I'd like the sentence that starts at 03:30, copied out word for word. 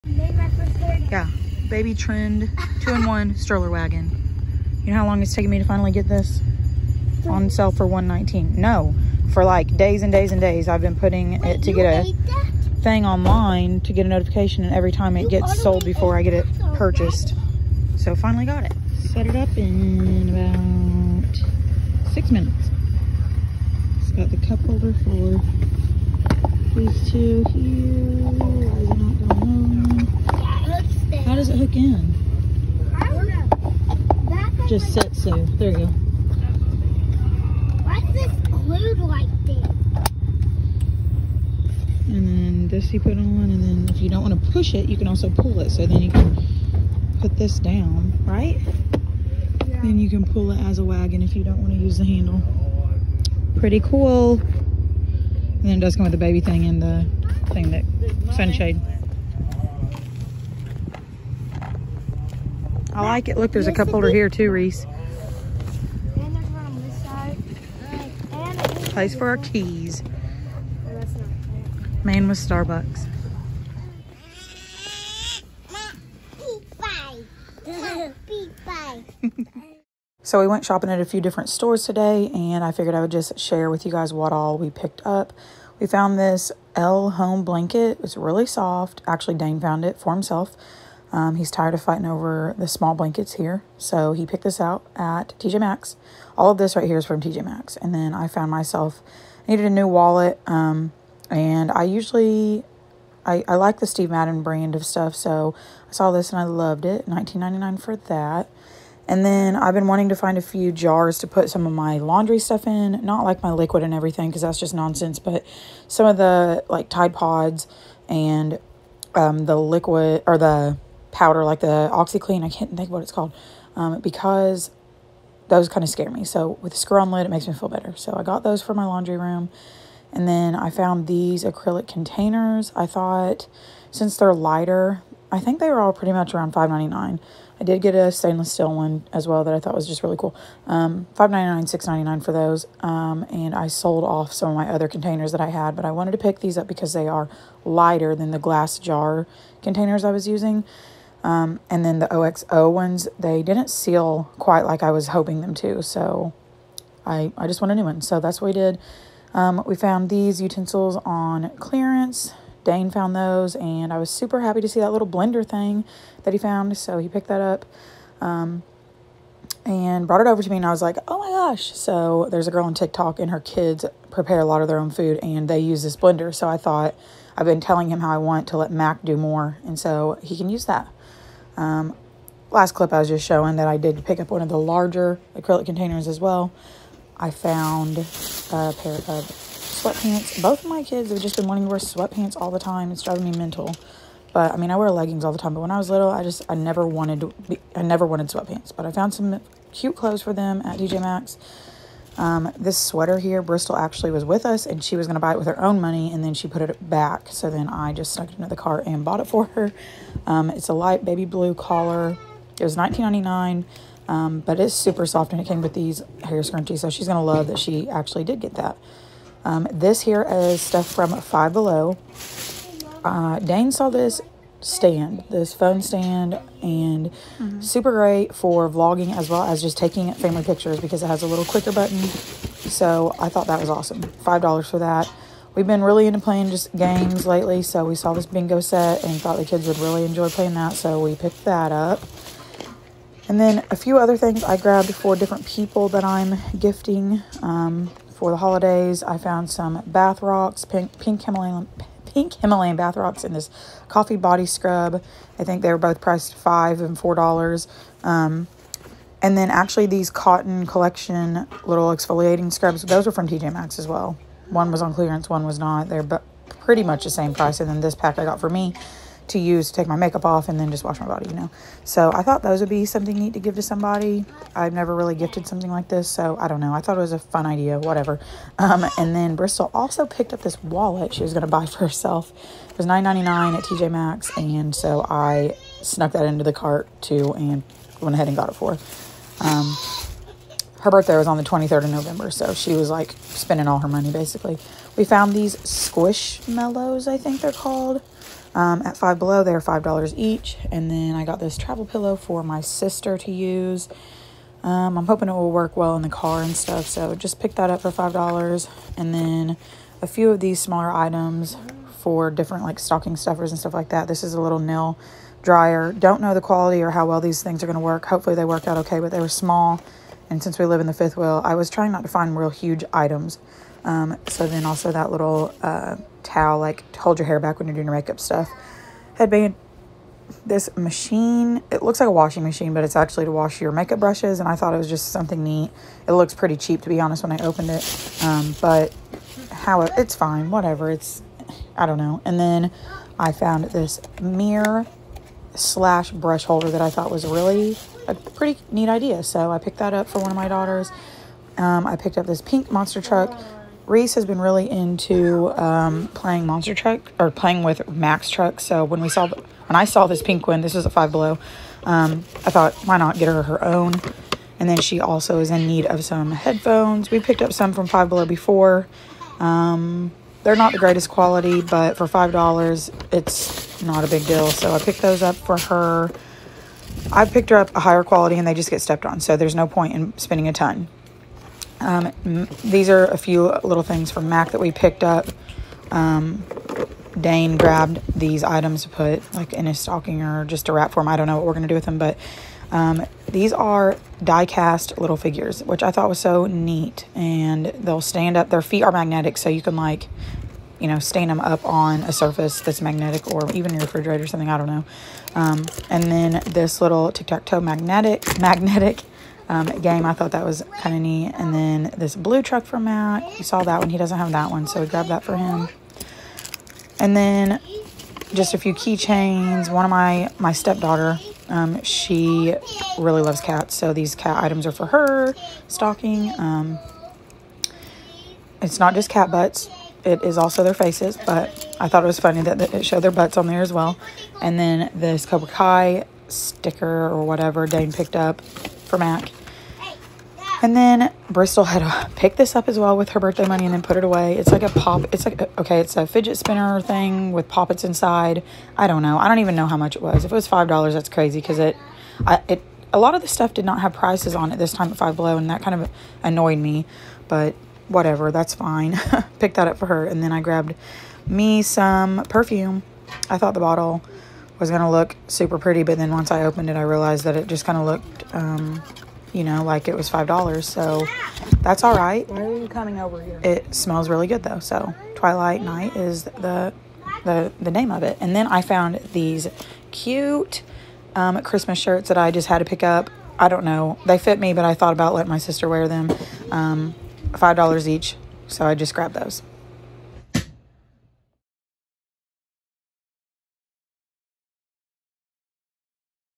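Um, it's a light baby blue collar.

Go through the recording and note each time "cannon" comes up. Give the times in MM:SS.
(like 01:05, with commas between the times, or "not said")
not said.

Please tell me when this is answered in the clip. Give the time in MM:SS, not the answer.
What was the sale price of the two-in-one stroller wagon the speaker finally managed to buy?
00:07.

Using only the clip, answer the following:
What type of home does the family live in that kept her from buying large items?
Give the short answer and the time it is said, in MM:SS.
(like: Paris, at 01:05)
fifth wheel, at 05:20.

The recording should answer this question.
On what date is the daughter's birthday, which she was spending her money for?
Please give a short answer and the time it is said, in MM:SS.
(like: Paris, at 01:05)
November 23, at 04:51.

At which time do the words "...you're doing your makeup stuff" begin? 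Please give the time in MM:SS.
05:27.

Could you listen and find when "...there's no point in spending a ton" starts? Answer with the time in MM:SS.
06:19.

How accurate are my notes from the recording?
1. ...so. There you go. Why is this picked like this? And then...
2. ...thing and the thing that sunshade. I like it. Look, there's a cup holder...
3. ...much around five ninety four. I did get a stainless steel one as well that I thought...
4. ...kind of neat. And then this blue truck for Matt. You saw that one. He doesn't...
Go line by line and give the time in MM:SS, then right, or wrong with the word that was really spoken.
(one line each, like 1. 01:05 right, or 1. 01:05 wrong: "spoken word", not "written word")
1. 00:35 wrong: "glued", not "picked"
2. 00:56 right
3. 02:16 wrong: "nine", not "four"
4. 06:50 right.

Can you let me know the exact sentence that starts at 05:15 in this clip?
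Don't know the quality or how well these things are going to work.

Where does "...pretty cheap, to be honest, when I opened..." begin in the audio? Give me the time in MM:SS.
05:36.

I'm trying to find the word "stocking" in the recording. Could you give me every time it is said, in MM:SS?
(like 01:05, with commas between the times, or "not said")
05:12, 06:29, 07:05.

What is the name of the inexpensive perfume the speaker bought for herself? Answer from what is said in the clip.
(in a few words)
Twilight Night.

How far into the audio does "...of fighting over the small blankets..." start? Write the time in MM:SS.
01:31.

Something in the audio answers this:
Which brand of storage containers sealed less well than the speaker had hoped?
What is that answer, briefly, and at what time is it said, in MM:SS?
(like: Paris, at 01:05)
OXO, at 02:32.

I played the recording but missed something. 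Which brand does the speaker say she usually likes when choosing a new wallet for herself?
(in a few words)
Steve Madden.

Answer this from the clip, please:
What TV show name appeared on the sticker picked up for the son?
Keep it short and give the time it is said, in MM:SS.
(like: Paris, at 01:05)
Cobra Kai, at 07:15.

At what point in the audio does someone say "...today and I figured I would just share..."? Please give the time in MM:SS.
01:21.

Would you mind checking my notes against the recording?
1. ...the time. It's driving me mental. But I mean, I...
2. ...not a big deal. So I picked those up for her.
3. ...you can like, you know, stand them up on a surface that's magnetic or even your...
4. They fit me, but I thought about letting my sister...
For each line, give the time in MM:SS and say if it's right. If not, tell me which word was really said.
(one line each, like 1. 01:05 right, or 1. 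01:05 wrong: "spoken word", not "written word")
1. 03:12 right
2. 06:13 right
3. 06:39 right
4. 08:04 right.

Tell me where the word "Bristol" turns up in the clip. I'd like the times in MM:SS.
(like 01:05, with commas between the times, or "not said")
03:23, 04:39, 07:21.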